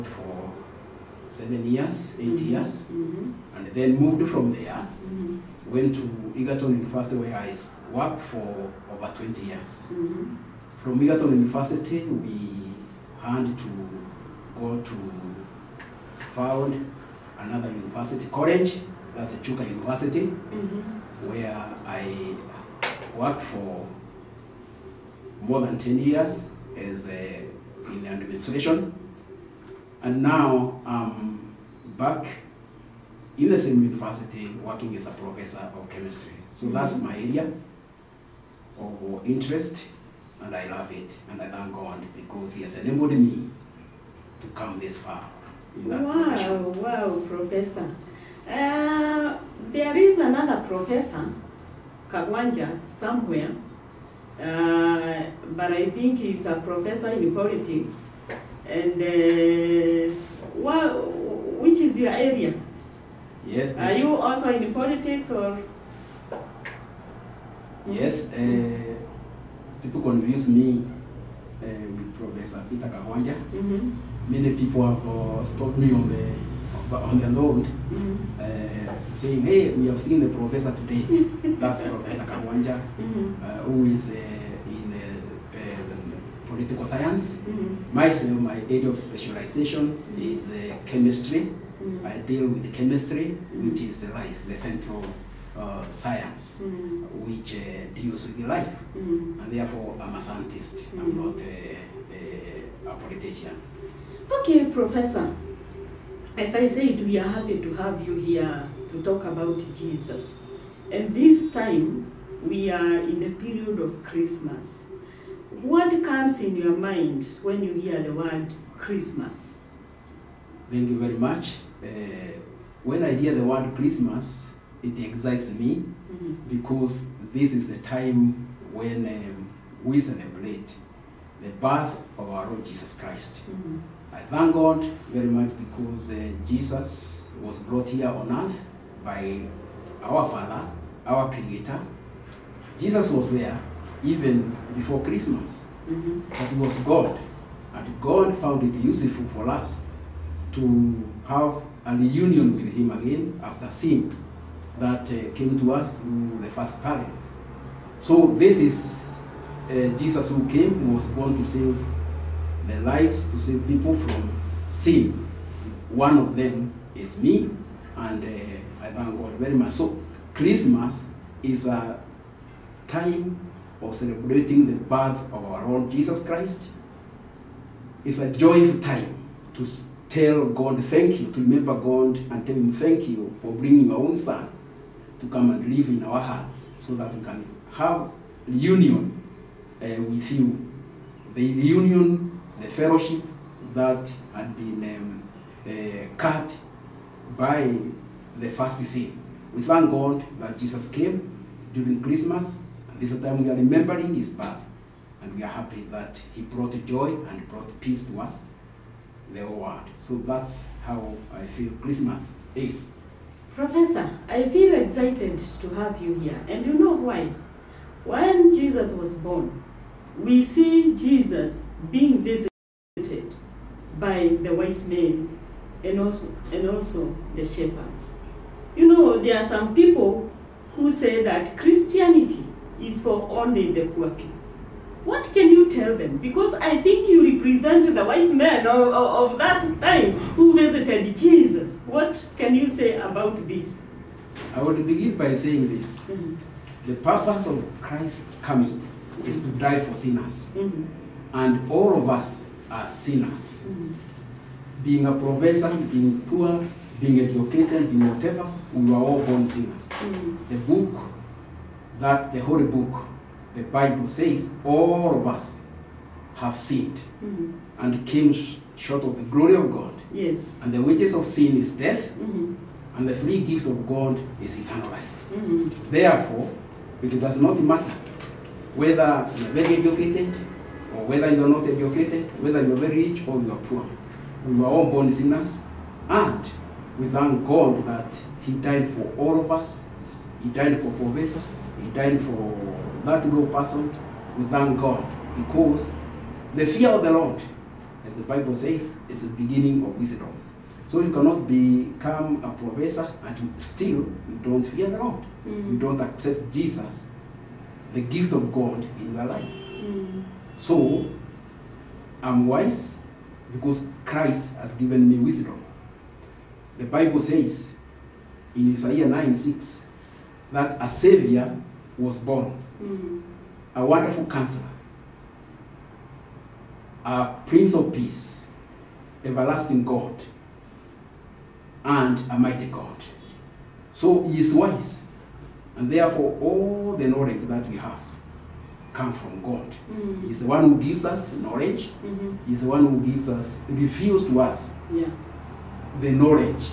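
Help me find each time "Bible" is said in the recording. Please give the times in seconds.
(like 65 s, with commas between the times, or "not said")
263 s, 298 s, 316 s.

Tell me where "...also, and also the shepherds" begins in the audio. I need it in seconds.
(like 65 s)
226 s.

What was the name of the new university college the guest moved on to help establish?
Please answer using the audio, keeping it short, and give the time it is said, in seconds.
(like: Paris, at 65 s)
Chuka University, at 19 s.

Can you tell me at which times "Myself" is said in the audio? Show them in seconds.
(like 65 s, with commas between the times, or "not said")
87 s.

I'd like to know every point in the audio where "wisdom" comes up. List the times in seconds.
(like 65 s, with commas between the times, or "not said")
299 s, 315 s.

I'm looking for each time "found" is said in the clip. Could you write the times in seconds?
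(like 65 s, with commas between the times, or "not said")
16 s, 148 s.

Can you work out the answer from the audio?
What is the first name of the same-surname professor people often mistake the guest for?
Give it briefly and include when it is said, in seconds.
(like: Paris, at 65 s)
Peter, at 72 s.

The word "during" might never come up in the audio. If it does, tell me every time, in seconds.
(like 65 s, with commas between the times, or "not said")
201 s.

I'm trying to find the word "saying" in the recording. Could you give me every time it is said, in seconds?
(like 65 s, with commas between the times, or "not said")
79 s, 245 s.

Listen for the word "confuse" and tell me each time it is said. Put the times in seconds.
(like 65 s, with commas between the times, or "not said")
70 s.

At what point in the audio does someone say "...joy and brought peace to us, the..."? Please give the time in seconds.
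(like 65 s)
206 s.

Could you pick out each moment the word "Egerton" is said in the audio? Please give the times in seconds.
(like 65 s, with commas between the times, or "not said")
6 s, 11 s.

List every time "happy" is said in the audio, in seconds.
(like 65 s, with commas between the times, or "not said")
107 s, 205 s.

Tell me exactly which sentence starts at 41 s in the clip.
And I thank God because He has enabled me to come this far.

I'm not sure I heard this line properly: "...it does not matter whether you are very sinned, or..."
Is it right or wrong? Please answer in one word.
wrong.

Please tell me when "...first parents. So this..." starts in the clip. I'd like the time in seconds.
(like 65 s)
156 s.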